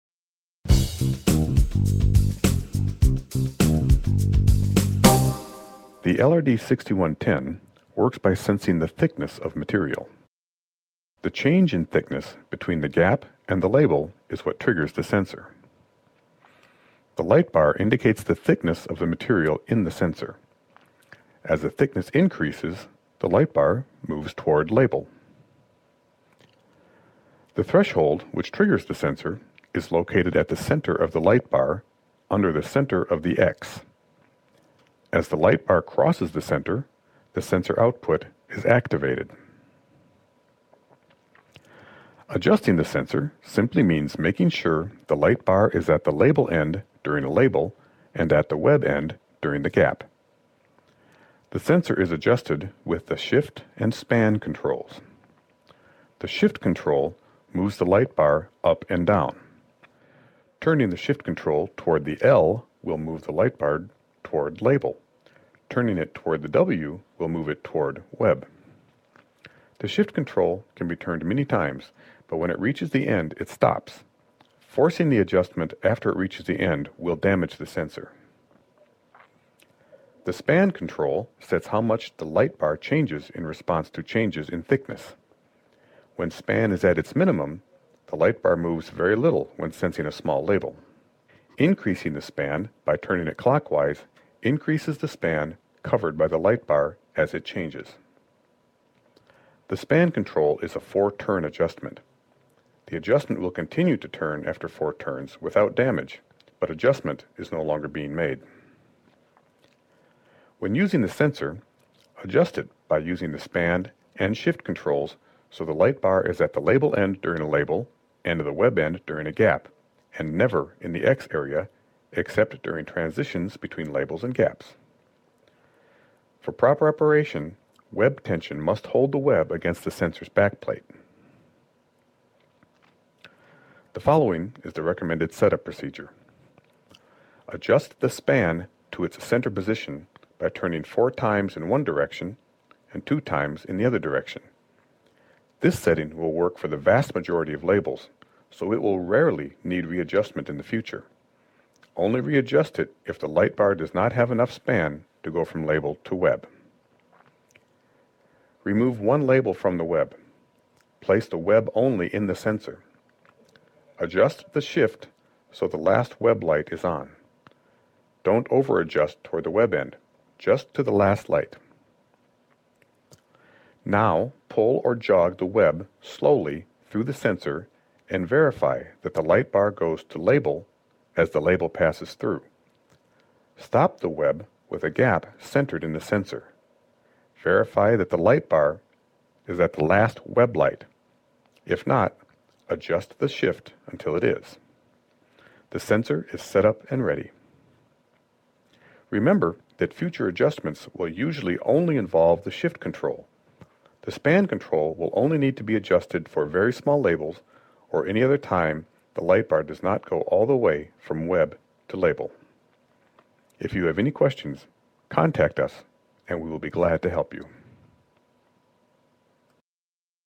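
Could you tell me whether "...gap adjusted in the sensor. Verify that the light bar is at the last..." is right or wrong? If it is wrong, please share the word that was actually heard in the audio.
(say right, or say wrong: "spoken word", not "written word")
wrong: "centered", not "adjusted".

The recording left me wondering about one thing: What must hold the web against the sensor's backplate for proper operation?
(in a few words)
Web tension.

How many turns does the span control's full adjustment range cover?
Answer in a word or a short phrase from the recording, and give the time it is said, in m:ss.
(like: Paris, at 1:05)
4, at 1:40.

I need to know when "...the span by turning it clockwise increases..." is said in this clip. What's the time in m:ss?
1:32.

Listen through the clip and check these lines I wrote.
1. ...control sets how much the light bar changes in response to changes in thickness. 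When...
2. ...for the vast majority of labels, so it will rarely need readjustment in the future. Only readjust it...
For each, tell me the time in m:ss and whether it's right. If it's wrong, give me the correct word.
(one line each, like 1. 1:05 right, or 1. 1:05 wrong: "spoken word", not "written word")
1. 1:20 right
2. 2:26 right.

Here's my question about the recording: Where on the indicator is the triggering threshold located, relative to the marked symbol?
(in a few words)
Under the center of the X.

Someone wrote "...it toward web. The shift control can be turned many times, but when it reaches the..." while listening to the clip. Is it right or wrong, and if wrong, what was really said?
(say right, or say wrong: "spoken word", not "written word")
right.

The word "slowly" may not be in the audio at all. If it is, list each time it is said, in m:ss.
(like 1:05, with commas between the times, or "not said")
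2:56.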